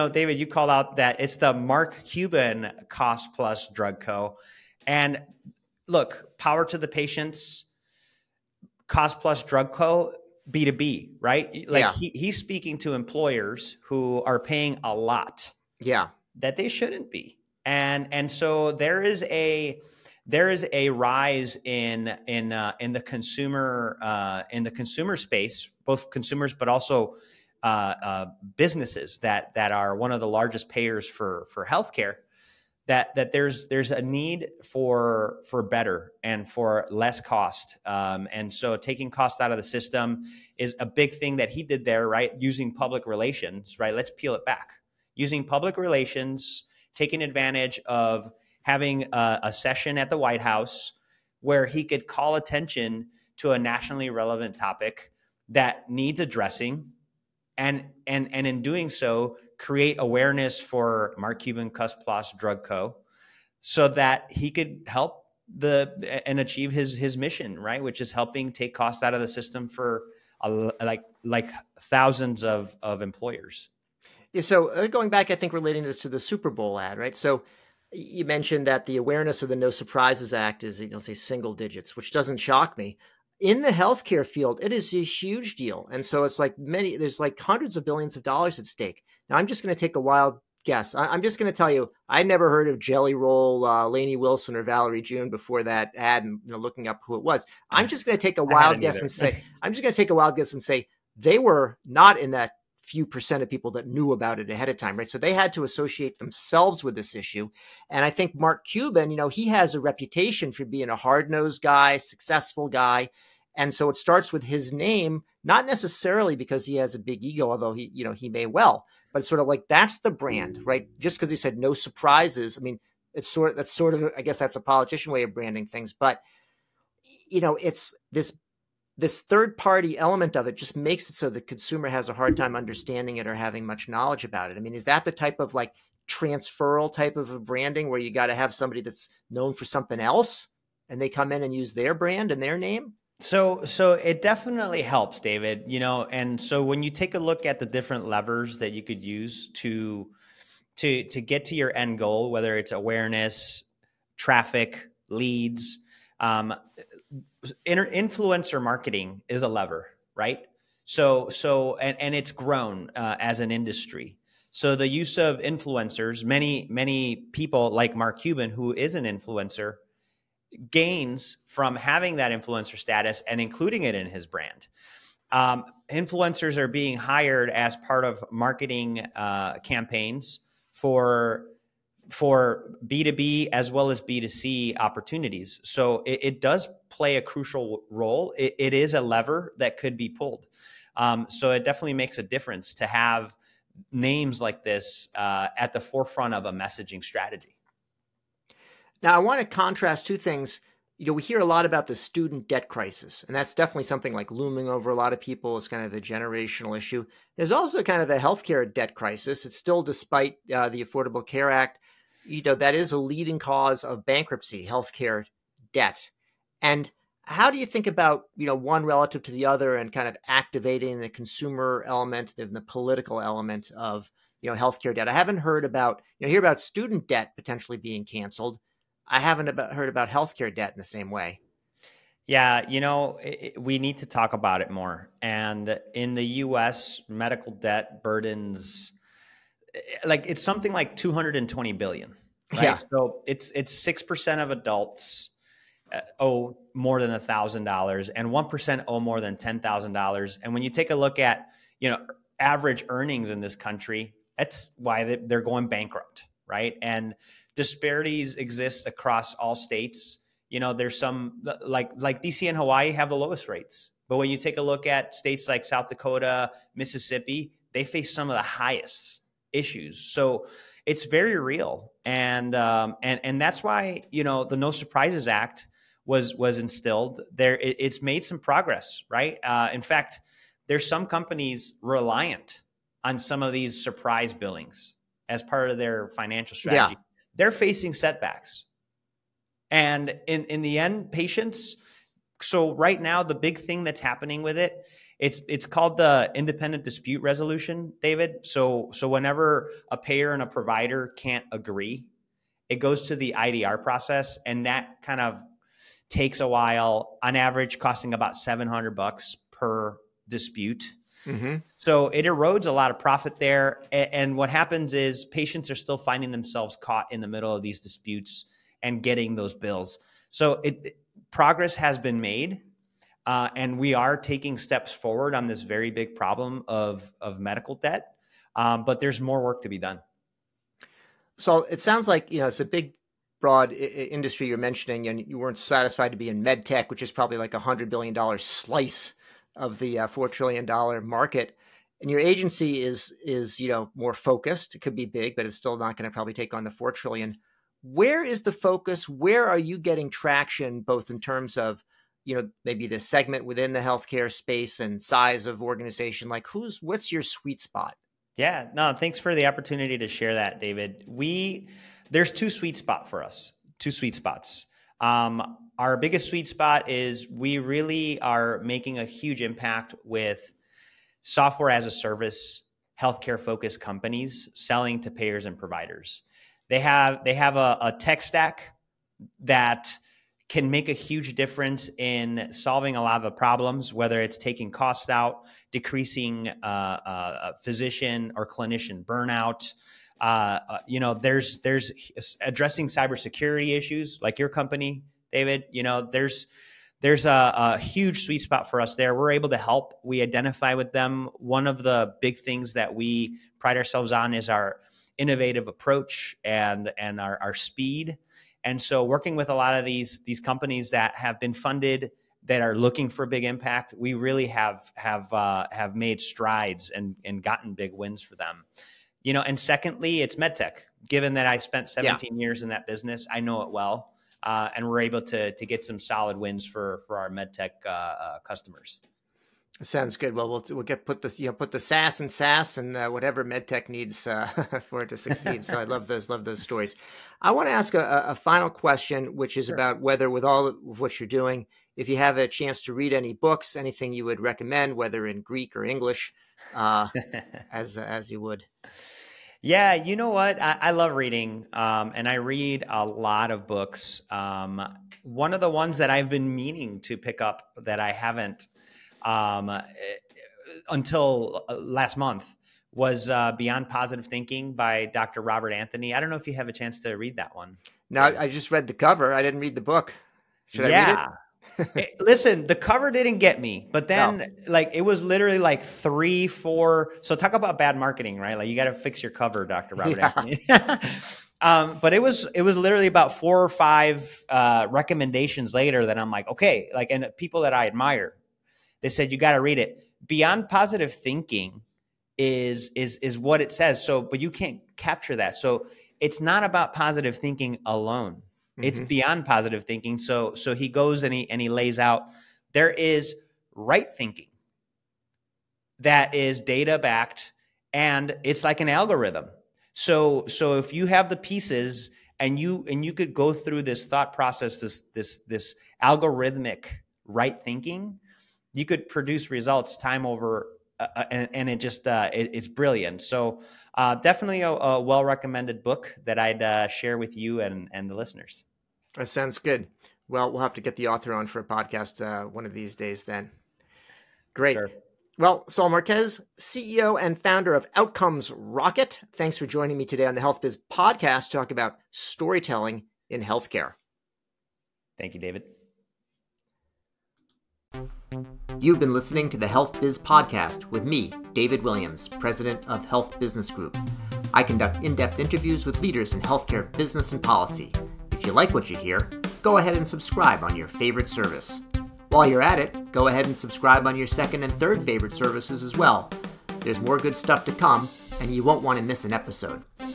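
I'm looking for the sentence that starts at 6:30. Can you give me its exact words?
Uh, uh you know, there's there's addressing cybersecurity issues like your company, David.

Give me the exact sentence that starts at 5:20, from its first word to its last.
So it progress has been made uh, and we are taking steps forward on this very big problem of, of medical debt.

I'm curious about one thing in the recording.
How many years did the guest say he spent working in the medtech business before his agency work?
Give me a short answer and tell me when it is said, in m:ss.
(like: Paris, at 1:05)
17, at 7:01.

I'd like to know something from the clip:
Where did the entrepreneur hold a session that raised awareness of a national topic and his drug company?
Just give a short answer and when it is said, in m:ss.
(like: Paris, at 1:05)
the White House, at 0:50.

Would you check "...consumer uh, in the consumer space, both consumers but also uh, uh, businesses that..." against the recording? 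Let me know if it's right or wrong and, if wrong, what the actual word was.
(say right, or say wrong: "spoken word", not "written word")
right.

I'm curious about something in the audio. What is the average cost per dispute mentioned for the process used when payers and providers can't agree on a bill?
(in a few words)
$700.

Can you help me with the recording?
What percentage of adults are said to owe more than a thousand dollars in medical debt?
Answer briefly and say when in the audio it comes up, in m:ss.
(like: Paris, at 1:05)
6 percent, at 4:03.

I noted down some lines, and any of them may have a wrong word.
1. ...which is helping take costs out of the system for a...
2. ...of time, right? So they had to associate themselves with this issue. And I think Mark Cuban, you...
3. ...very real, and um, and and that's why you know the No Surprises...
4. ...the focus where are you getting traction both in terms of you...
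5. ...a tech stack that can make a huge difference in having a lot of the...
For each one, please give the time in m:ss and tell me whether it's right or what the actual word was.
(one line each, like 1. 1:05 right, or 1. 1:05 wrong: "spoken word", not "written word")
1. 1:07 right
2. 1:44 right
3. 4:31 right
4. 5:48 right
5. 6:17 wrong: "solving", not "having".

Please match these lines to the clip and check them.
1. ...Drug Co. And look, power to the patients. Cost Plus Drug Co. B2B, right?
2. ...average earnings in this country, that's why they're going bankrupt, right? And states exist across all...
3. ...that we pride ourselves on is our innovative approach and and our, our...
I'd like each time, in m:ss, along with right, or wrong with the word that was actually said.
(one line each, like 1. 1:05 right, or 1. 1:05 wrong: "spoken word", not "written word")
1. 0:03 right
2. 4:12 wrong: "disparities", not "states"
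3. 6:42 right.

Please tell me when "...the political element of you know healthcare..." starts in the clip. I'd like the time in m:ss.
3:42.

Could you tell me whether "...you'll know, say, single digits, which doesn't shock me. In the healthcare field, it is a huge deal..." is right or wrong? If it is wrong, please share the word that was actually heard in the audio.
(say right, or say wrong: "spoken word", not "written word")
right.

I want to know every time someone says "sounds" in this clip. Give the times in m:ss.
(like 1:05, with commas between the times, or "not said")
5:31, 7:09, 8:49.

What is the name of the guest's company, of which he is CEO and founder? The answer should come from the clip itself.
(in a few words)
Outcomes Rocket.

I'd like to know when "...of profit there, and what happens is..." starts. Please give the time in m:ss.
5:12.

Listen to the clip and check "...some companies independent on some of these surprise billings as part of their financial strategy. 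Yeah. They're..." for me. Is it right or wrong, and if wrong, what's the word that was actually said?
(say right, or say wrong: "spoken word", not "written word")
wrong: "reliant", not "independent".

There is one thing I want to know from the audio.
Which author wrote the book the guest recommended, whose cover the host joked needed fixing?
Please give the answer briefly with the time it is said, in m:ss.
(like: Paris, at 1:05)
Dr. Robert Anthony, at 7:45.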